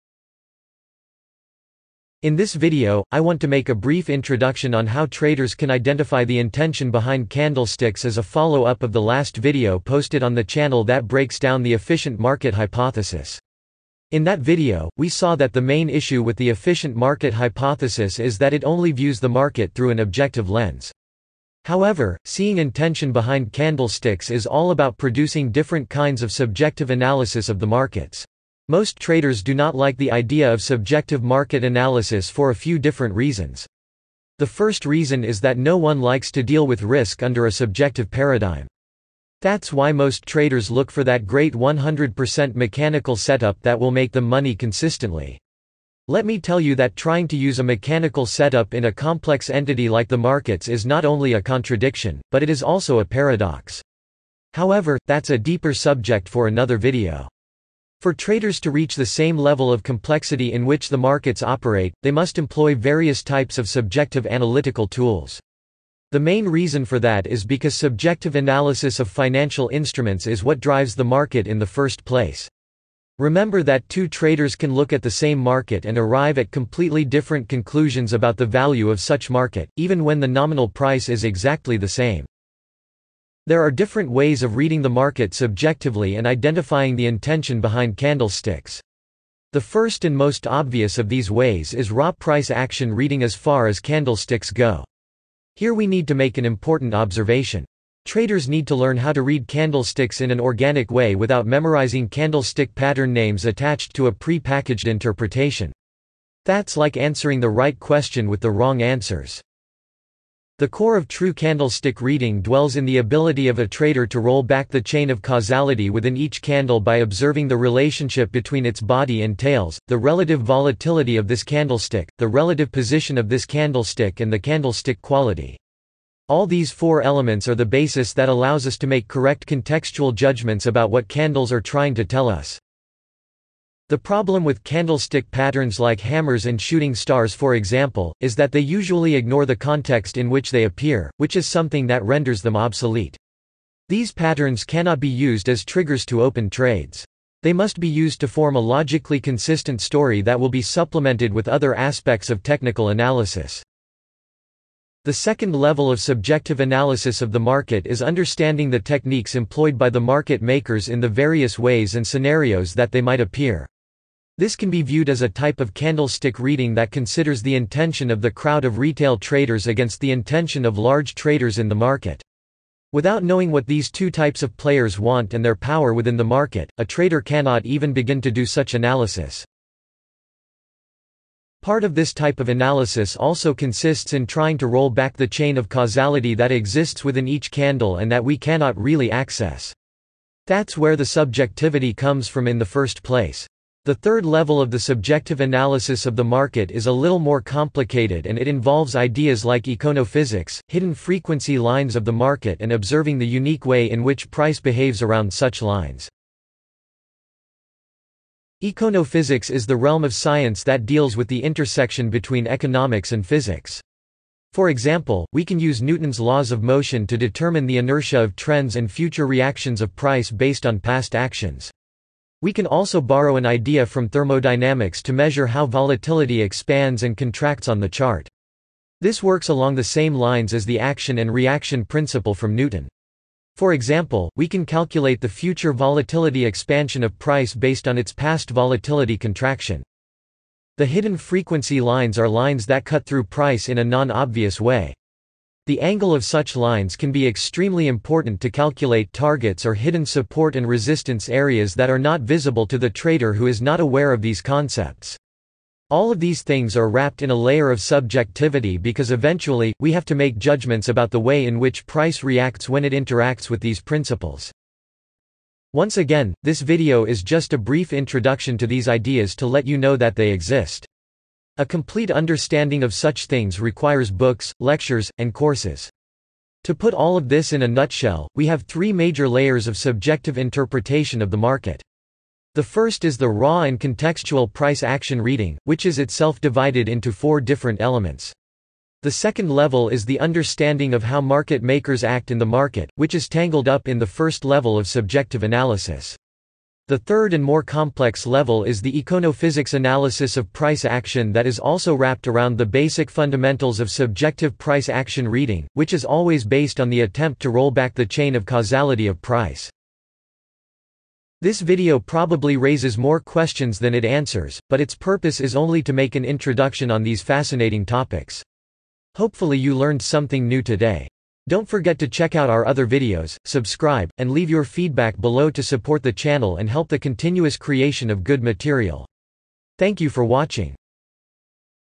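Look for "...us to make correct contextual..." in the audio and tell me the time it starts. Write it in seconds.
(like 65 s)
128 s.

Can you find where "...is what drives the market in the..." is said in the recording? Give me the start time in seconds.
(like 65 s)
70 s.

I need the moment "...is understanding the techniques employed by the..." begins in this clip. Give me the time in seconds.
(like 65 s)
157 s.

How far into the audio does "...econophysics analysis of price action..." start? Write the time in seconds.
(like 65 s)
299 s.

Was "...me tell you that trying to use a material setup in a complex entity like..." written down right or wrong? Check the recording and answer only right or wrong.
wrong.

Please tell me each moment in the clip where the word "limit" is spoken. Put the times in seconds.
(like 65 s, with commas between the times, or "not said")
not said.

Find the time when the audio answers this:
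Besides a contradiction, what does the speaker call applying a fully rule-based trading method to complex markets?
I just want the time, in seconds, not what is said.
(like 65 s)
53 s.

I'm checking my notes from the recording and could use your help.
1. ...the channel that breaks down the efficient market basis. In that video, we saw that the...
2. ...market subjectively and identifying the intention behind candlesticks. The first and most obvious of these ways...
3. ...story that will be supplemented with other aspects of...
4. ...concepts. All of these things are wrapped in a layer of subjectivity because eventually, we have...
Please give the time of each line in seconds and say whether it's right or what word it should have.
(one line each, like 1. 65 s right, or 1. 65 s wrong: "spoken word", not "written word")
1. 10 s wrong: "hypothesis", not "basis"
2. 84 s right
3. 149 s right
4. 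254 s right.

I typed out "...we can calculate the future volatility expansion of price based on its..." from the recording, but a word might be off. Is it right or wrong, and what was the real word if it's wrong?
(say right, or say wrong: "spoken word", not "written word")
right.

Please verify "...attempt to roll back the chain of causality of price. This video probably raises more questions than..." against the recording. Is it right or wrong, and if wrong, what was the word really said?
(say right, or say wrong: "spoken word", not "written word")
right.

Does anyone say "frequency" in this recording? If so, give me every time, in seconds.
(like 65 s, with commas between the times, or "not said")
200 s, 241 s.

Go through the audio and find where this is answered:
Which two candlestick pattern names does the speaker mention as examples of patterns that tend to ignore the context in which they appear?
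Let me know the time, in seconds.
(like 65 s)
135 s.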